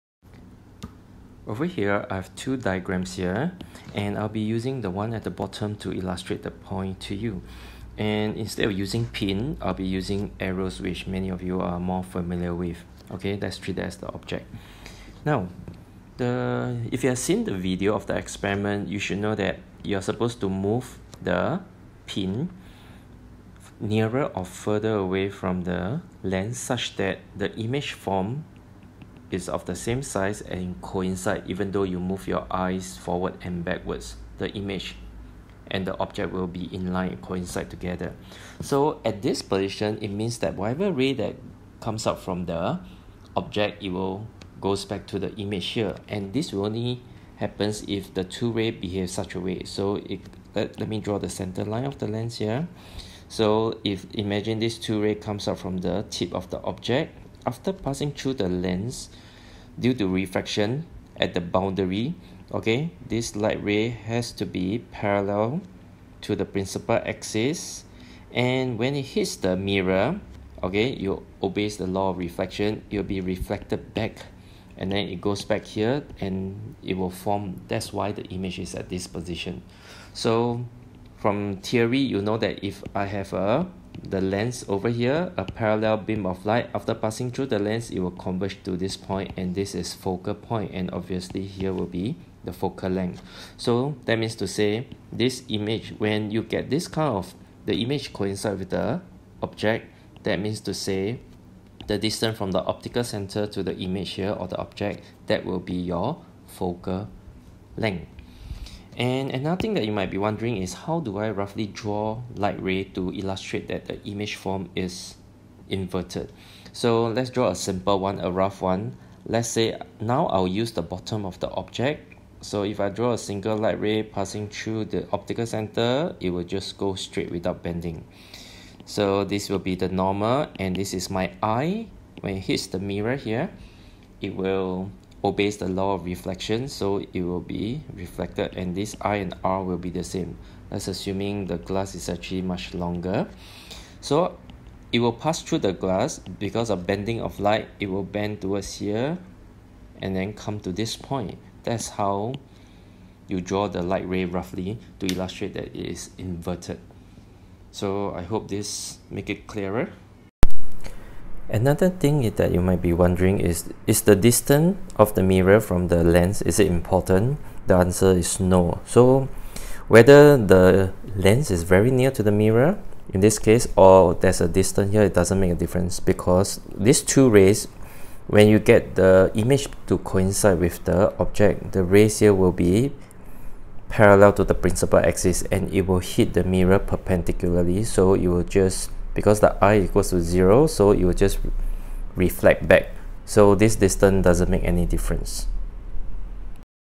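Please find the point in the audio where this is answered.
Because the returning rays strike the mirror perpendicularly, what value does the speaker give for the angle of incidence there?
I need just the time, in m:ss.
3:10.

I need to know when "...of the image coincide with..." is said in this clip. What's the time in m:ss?
1:37.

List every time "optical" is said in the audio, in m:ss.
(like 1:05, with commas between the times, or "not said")
1:42, 2:05.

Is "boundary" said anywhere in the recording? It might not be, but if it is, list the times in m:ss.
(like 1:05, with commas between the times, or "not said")
1:01.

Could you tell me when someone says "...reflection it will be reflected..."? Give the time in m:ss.
1:12.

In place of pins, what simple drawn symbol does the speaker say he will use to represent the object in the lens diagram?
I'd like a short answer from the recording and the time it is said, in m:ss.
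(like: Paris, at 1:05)
arrows, at 0:10.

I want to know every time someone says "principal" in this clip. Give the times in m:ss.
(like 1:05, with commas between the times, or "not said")
1:06, 3:04.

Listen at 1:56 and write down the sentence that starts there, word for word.
So let's draw a simple one, a rough one.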